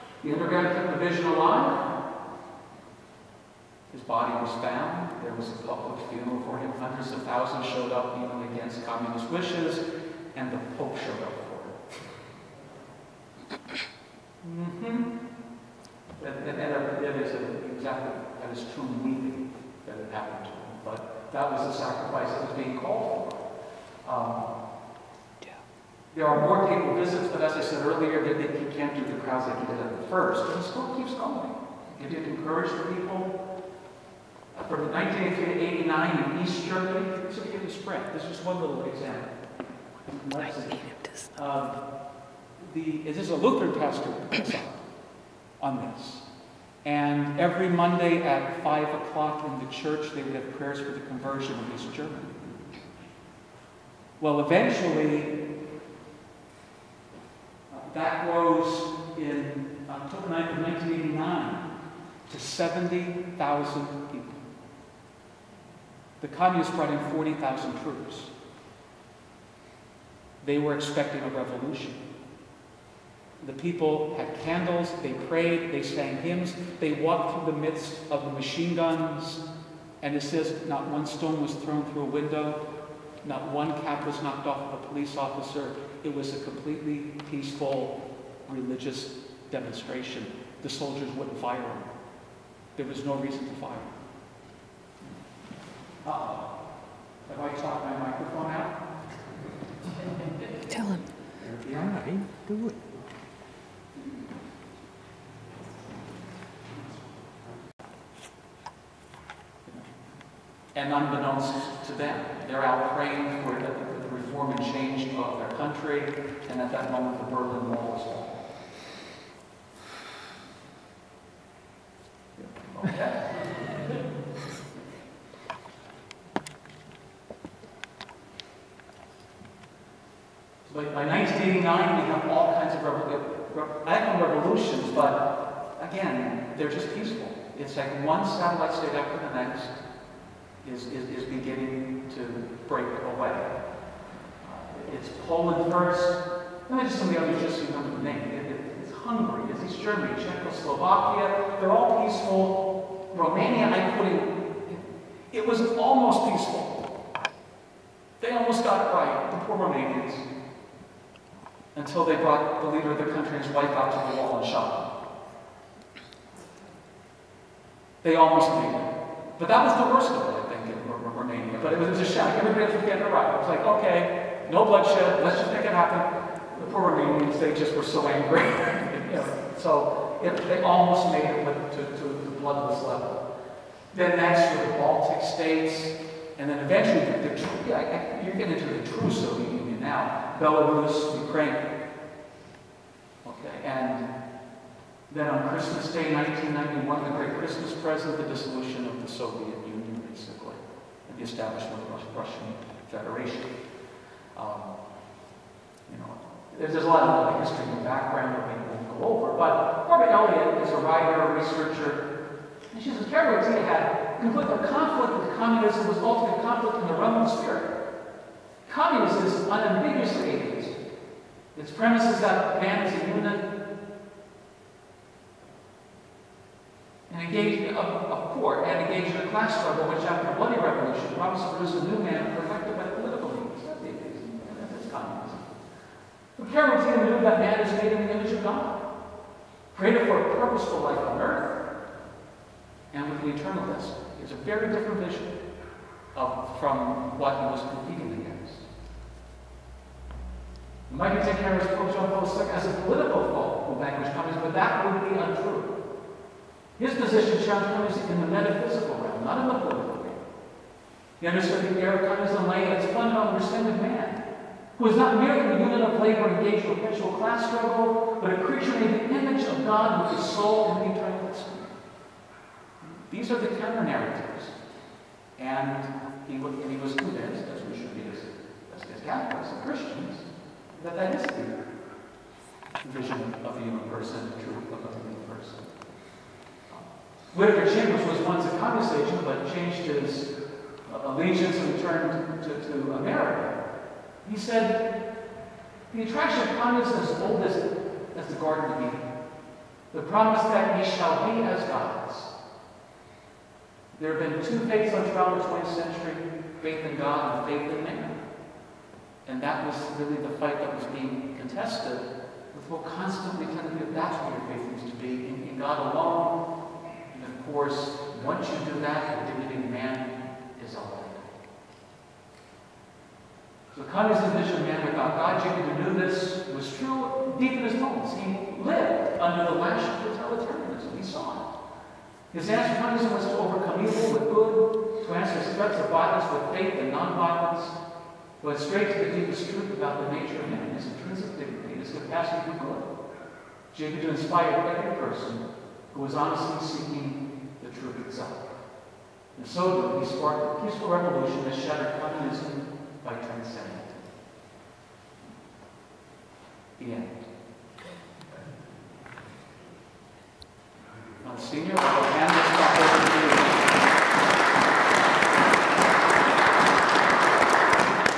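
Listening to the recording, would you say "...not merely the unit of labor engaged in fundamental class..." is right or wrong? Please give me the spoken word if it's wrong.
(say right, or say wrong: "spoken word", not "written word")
wrong: "perpetual", not "fundamental".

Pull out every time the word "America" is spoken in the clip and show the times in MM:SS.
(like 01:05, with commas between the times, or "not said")
04:52.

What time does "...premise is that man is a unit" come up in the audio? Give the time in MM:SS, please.
03:41.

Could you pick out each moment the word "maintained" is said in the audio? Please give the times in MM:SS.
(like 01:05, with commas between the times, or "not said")
not said.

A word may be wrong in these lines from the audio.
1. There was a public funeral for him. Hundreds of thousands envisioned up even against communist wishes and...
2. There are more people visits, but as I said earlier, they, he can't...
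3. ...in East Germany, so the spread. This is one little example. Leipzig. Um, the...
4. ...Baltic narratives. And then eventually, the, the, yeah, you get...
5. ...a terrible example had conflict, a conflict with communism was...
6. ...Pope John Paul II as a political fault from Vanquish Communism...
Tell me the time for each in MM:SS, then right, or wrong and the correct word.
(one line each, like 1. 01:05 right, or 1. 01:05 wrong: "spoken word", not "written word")
1. 00:05 wrong: "showed", not "envisioned"
2. 00:26 right
3. 00:36 right
4. 03:04 wrong: "states", not "narratives"
5. 03:32 right
6. 04:11 right.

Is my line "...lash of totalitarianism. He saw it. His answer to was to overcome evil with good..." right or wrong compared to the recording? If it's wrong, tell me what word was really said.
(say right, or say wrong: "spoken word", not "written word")
right.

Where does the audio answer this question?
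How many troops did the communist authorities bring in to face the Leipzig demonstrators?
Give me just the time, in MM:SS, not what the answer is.
01:07.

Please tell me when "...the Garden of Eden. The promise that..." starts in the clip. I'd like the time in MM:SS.
04:58.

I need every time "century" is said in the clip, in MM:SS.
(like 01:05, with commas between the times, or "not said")
05:05.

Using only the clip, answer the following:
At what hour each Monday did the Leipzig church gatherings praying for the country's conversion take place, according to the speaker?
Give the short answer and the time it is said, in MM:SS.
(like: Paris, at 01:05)
5 o'clock, at 00:48.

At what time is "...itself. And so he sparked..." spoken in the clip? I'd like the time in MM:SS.
05:48.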